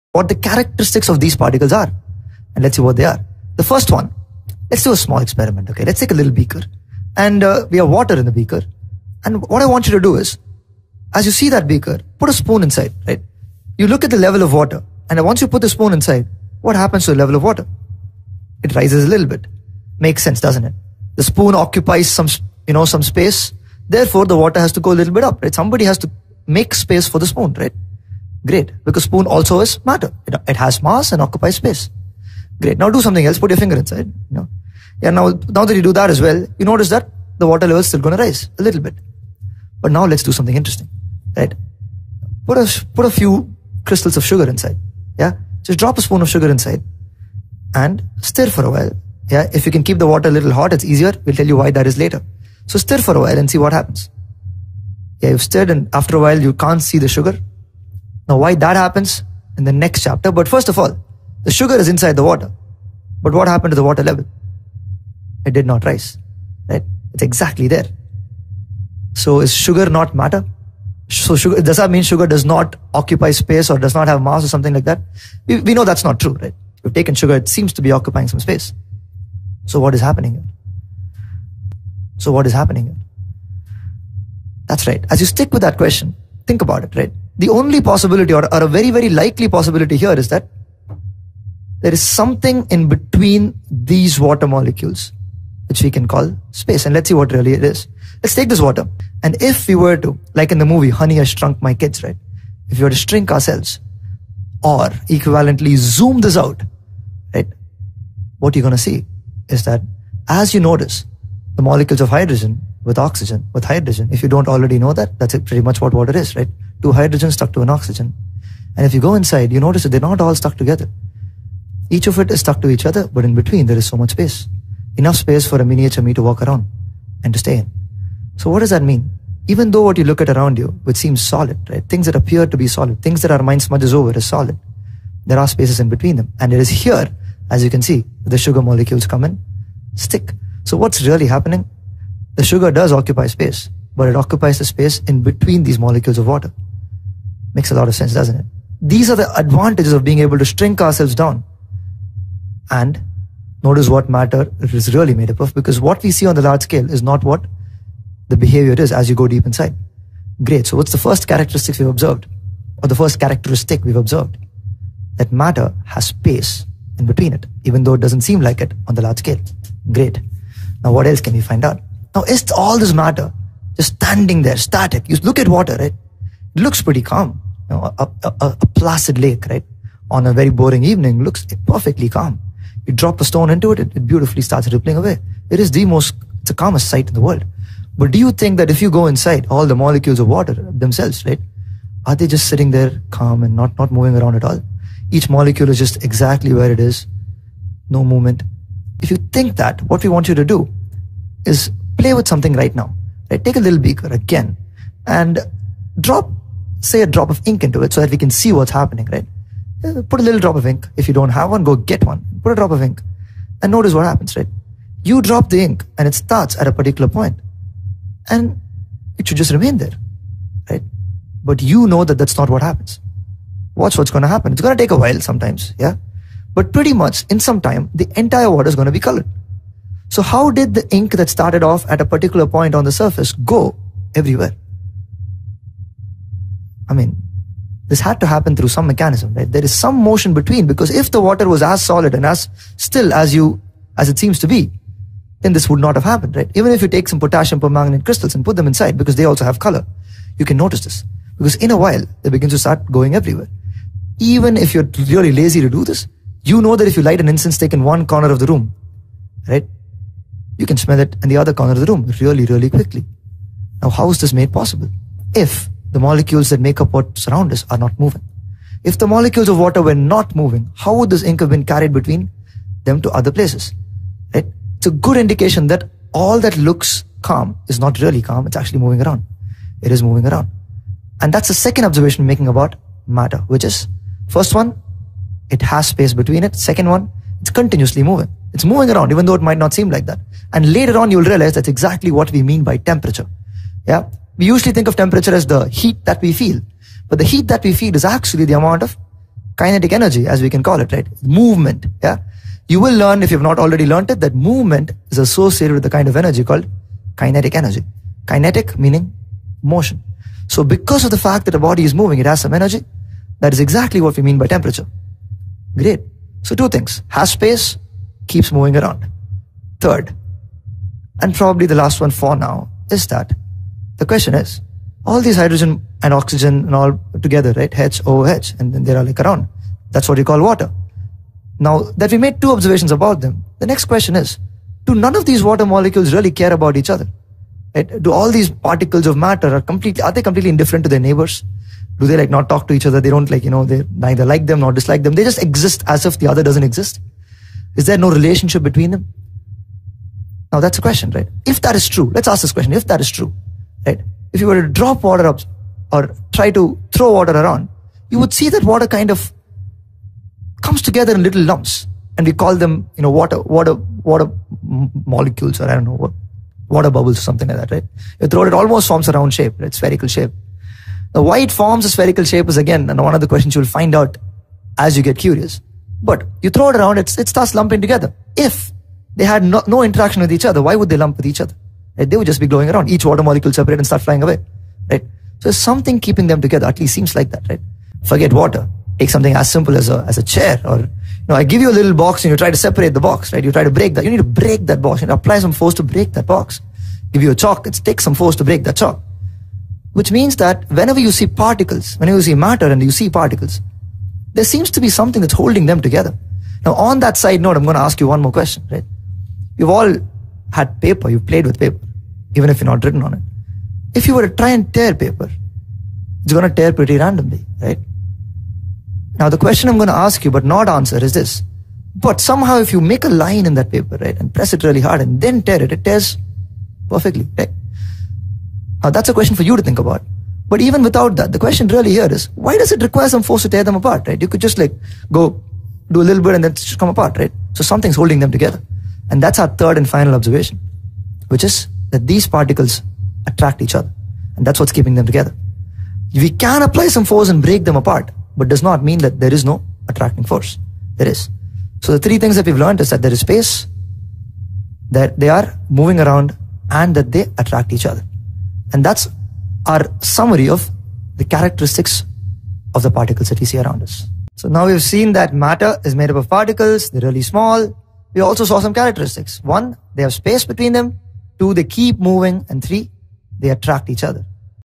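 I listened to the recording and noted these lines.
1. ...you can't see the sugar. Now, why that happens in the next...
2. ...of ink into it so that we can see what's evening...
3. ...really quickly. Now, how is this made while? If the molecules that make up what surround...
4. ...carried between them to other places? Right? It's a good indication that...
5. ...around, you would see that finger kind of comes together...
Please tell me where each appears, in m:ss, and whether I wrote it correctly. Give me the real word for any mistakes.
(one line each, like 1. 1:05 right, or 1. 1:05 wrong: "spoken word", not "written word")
1. 0:56 right
2. 3:27 wrong: "happening", not "evening"
3. 4:22 wrong: "possible", not "while"
4. 4:31 right
5. 5:57 wrong: "water", not "finger".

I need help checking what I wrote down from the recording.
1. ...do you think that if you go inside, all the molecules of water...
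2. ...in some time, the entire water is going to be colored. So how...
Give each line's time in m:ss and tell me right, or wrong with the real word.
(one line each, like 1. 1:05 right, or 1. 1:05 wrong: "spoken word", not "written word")
1. 3:08 right
2. 3:47 right.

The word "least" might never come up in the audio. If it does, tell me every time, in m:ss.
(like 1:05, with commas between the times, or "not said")
6:26.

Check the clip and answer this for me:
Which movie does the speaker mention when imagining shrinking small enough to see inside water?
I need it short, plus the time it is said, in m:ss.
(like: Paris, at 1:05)
Honey, I Shrunk My Kids, at 1:40.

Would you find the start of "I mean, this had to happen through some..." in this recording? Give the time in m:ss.
3:56.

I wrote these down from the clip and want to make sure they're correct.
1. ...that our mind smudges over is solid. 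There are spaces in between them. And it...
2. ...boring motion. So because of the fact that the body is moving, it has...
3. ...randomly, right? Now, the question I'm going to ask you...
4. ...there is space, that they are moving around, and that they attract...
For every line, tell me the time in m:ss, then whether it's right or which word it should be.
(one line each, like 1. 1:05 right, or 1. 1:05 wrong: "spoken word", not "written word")
1. 2:13 right
2. 5:08 wrong: "meaning", not "boring"
3. 6:56 right
4. 7:33 right.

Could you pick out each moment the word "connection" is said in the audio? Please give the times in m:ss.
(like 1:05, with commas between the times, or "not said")
not said.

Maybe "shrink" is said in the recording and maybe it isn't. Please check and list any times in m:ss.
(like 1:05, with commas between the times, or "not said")
1:42, 2:30.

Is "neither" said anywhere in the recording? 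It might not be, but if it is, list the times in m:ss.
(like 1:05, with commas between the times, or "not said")
5:43.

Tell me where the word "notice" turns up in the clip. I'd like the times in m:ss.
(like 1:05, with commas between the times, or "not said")
0:36, 1:50, 1:59, 2:33, 3:33, 4:10.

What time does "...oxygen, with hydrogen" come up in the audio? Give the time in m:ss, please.
1:52.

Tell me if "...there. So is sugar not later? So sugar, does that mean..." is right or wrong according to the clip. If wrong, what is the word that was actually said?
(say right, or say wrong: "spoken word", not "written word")
wrong: "matter", not "later".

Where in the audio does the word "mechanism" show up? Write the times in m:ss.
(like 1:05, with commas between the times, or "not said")
3:58.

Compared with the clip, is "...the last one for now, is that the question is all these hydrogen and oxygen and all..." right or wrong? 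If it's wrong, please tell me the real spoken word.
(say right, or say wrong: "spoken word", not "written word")
right.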